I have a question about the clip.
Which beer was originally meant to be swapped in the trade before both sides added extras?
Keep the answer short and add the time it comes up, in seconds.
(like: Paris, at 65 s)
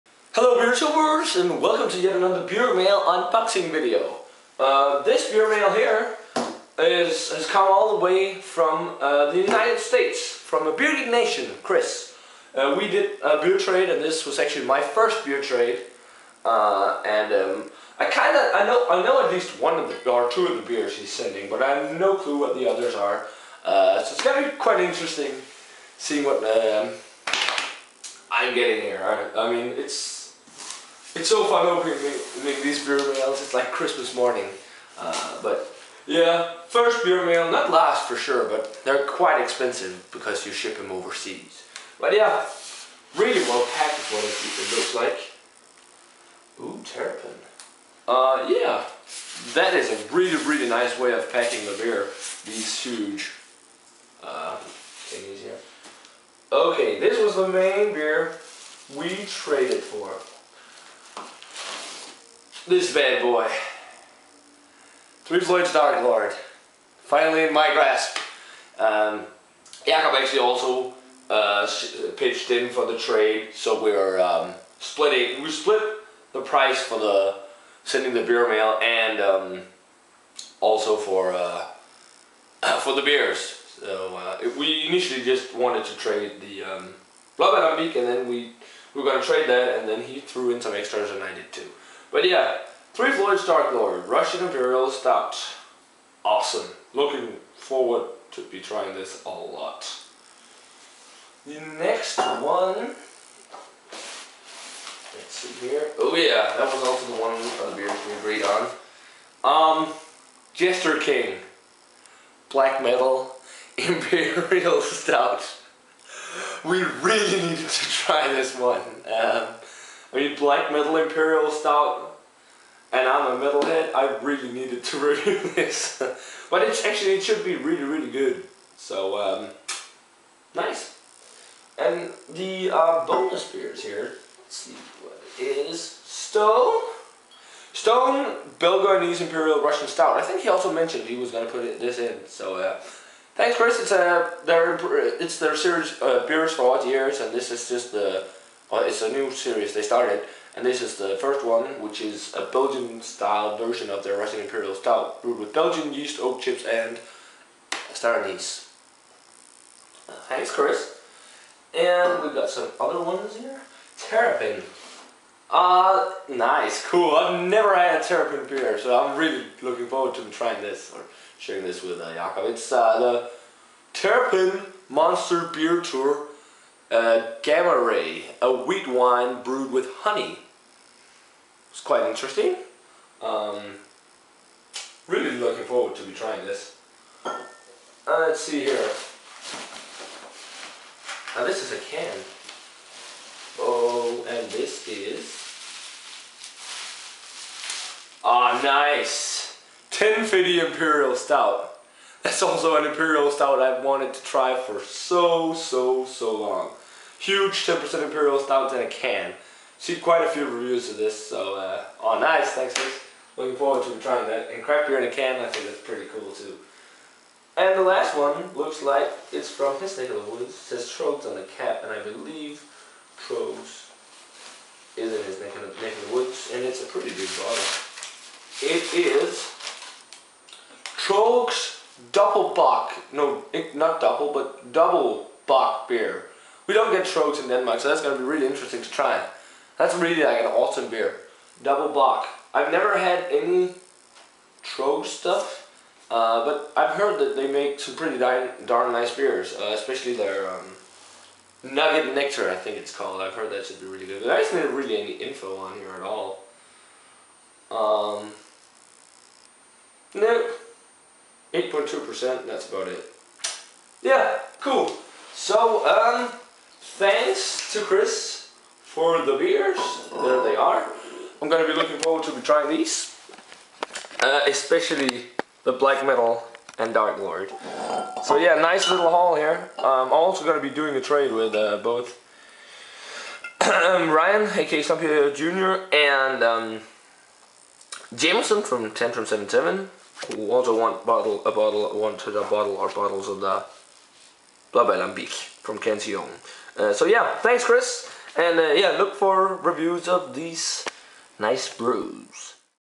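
Blood and Beak, at 87 s.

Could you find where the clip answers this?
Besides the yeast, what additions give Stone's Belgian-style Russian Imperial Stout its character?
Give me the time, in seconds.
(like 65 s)
156 s.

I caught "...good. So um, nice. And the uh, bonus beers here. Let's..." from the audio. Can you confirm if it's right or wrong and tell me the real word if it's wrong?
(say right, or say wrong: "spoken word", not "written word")
right.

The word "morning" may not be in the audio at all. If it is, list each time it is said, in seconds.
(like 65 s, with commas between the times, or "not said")
34 s.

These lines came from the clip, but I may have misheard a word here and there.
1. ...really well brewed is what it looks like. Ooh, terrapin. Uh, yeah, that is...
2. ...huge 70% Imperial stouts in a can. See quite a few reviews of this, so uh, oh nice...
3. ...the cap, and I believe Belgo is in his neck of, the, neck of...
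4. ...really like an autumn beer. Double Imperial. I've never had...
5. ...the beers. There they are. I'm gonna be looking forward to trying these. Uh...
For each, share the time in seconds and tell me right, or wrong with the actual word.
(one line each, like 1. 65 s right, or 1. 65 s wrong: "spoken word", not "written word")
1. 43 s wrong: "packed", not "brewed"
2. 207 s wrong: "10", not "70"
3. 221 s wrong: "Tröegs", not "Belgo"
4. 239 s wrong: "Bock", not "Imperial"
5. 269 s right.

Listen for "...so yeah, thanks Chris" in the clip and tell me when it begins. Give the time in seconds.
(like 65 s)
296 s.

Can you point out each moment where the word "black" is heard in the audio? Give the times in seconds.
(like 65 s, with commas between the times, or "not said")
112 s, 120 s, 275 s.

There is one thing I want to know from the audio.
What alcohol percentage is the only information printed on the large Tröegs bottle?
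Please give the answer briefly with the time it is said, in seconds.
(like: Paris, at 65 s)
8.2%, at 261 s.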